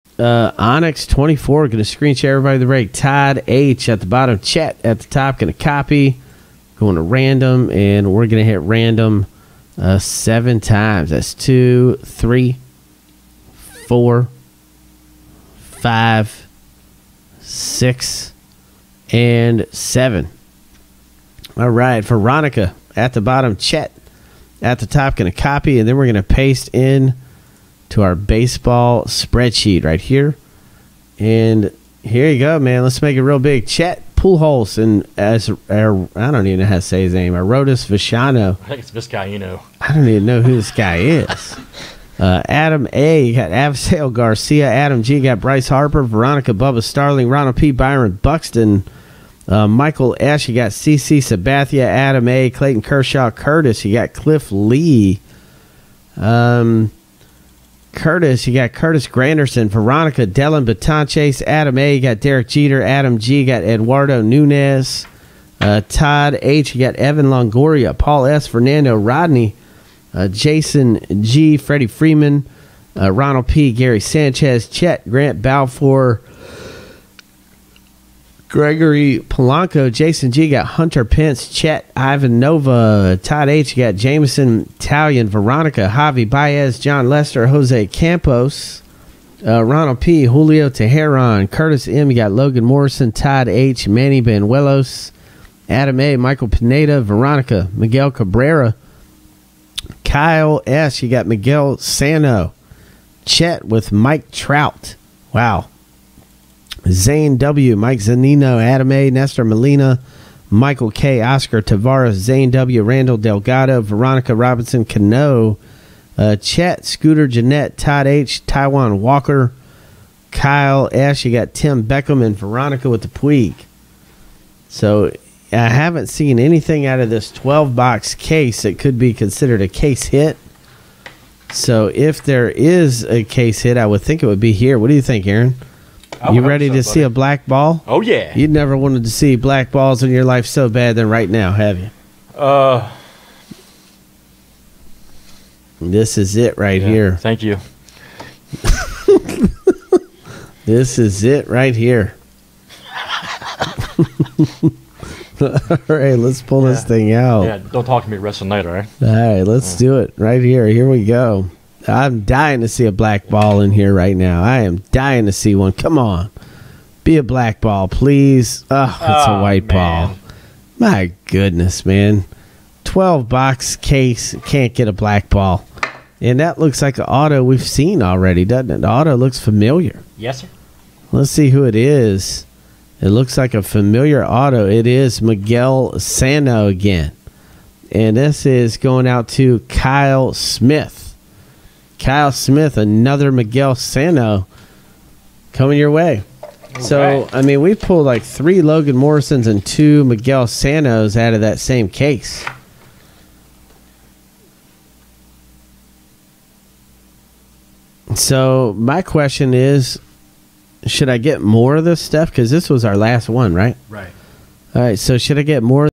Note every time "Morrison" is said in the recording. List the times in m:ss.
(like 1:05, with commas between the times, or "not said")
1:32, 3:18.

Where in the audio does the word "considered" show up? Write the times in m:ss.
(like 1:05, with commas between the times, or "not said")
2:09.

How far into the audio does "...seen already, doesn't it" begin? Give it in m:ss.
2:57.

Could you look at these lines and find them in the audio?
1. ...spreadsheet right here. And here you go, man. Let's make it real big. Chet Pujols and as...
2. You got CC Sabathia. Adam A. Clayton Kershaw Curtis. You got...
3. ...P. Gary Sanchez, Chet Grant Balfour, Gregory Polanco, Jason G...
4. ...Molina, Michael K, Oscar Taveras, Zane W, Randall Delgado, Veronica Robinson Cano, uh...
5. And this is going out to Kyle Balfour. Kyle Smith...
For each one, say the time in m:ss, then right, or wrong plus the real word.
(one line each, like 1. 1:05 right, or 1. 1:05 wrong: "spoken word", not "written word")
1. 0:29 right
2. 0:50 right
3. 1:13 right
4. 1:49 right
5. 3:07 wrong: "Smith", not "Balfour".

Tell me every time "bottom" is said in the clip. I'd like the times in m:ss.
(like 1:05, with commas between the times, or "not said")
0:04, 0:23.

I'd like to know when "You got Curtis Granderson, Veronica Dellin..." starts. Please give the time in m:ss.
0:58.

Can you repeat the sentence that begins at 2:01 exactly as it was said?
You got Tim Beckham and Veronica with the Puig.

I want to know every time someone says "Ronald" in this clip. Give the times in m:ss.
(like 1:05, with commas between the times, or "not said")
0:47, 1:13, 1:29.